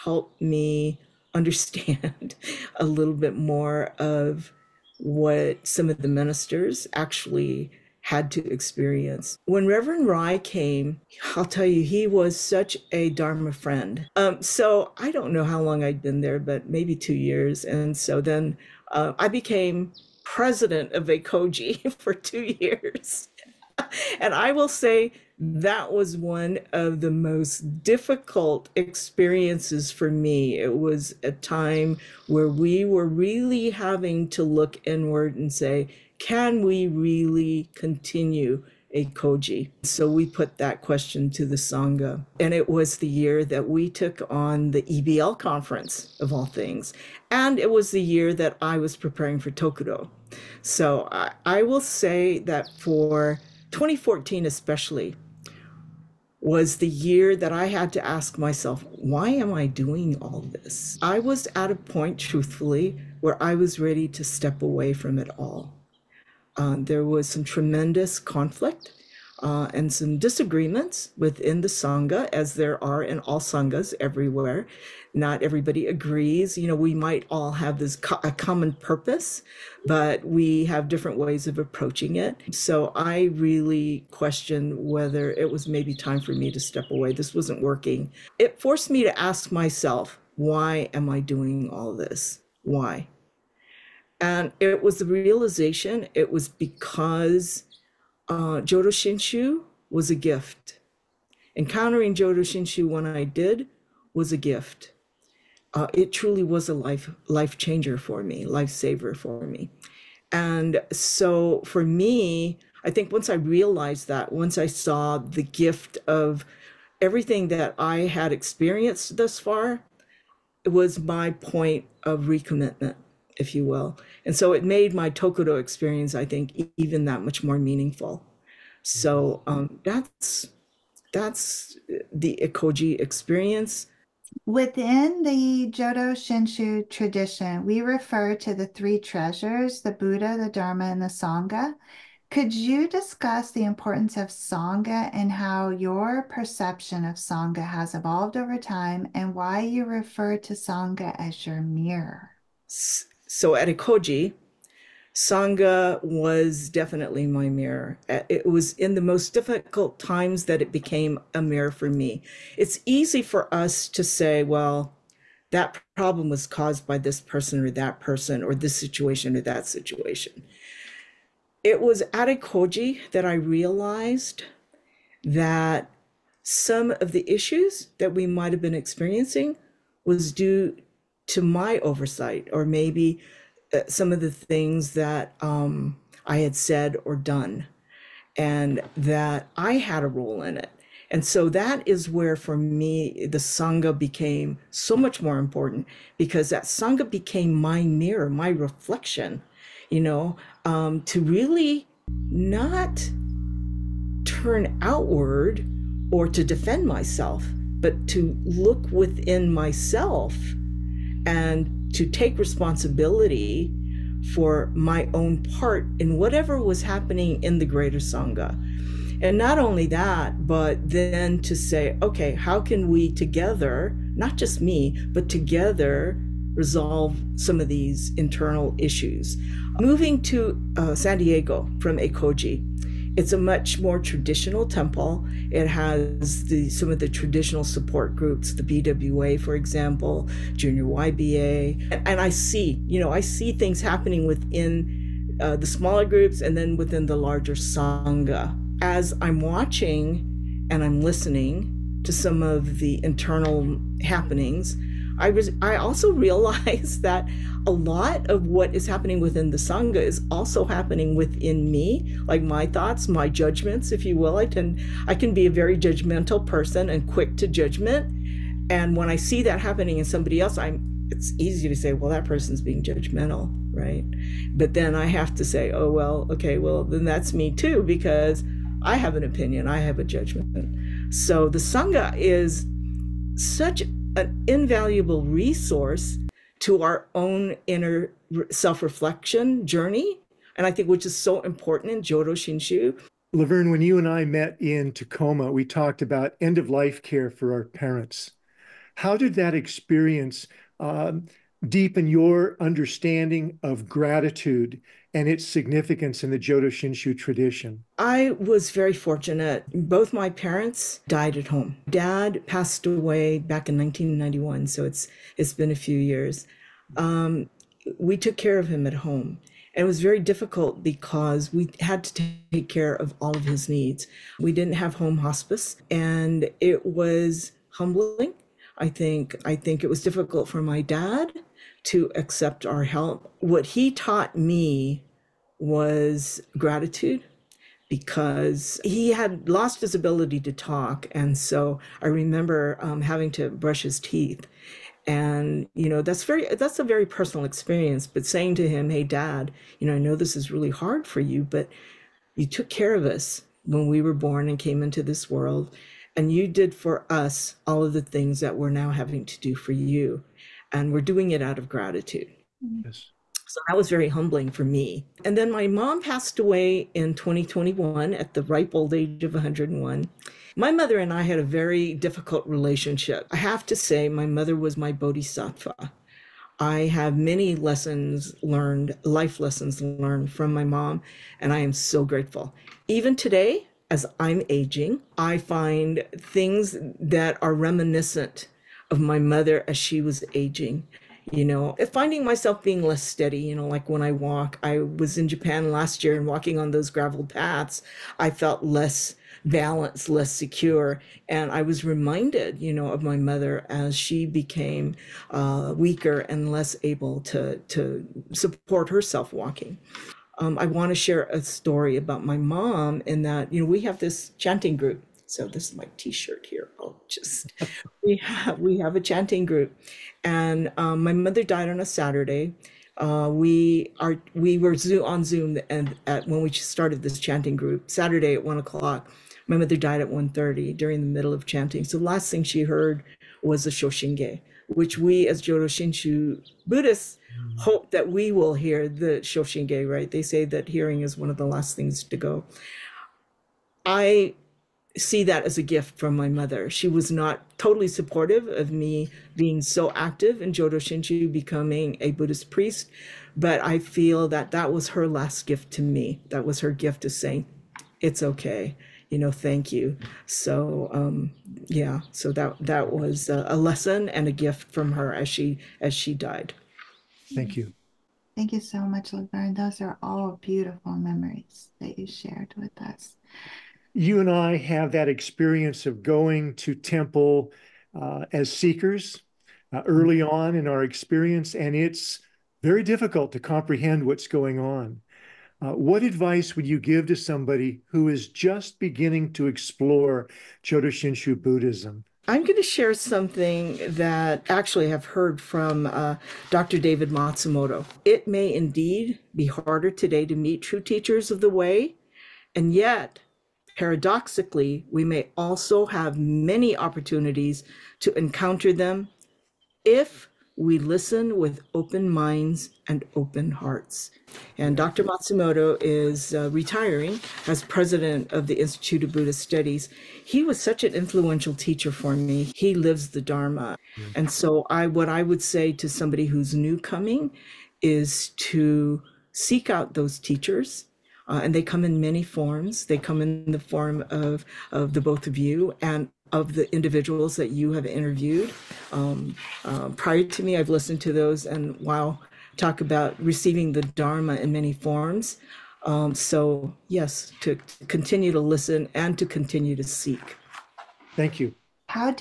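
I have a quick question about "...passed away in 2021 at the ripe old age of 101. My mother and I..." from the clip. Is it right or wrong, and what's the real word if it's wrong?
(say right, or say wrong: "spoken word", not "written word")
right.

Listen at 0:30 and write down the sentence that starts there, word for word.
It was a time where we were really having to look inward and say, can we really continue Ekoji?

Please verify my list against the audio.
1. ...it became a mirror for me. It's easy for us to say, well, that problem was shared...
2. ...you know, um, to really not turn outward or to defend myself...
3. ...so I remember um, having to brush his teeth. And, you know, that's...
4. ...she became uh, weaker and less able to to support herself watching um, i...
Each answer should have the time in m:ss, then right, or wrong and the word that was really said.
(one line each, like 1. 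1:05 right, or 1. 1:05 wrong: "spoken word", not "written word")
1. 2:40 wrong: "caused", not "shared"
2. 3:19 right
3. 5:41 right
4. 6:43 wrong: "walking", not "watching".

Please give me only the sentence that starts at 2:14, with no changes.
Within the Jodo Shinshu tradition, we refer to the three treasures the Buddha, the Dharma, and the Sangha.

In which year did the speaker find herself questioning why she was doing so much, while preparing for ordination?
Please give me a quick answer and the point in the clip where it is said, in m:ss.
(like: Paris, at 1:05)
2014, at 0:53.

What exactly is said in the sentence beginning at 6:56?
I'll just we have we have a chanting group, and um, my mother died on a Saturday.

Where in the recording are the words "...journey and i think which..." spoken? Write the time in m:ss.
4:49.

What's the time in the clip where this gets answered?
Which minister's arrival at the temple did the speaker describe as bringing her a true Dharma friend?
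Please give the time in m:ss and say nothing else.
0:09.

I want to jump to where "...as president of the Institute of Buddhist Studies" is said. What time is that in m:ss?
8:37.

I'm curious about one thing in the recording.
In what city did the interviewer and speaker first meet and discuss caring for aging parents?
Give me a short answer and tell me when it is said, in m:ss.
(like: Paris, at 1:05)
Tacoma, at 4:54.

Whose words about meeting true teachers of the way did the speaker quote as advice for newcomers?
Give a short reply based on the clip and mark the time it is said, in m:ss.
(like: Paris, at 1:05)
Dr. David Matsumoto, at 8:16.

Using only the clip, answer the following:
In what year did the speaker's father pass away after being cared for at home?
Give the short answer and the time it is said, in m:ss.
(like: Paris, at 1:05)
1991, at 5:13.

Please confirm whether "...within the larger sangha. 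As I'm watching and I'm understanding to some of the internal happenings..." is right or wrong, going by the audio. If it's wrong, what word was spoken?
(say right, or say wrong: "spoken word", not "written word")
wrong: "listening", not "understanding".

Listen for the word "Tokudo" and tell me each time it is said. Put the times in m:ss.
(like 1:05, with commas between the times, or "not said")
0:49, 2:05.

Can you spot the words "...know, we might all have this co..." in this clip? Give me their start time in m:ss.
1:16.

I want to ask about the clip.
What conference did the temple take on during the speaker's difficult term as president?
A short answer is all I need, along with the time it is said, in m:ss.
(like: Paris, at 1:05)
EBL conference, at 0:44.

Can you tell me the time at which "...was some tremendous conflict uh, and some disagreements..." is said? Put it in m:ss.
1:07.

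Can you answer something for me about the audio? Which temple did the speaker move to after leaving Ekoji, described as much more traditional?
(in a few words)
San Diego.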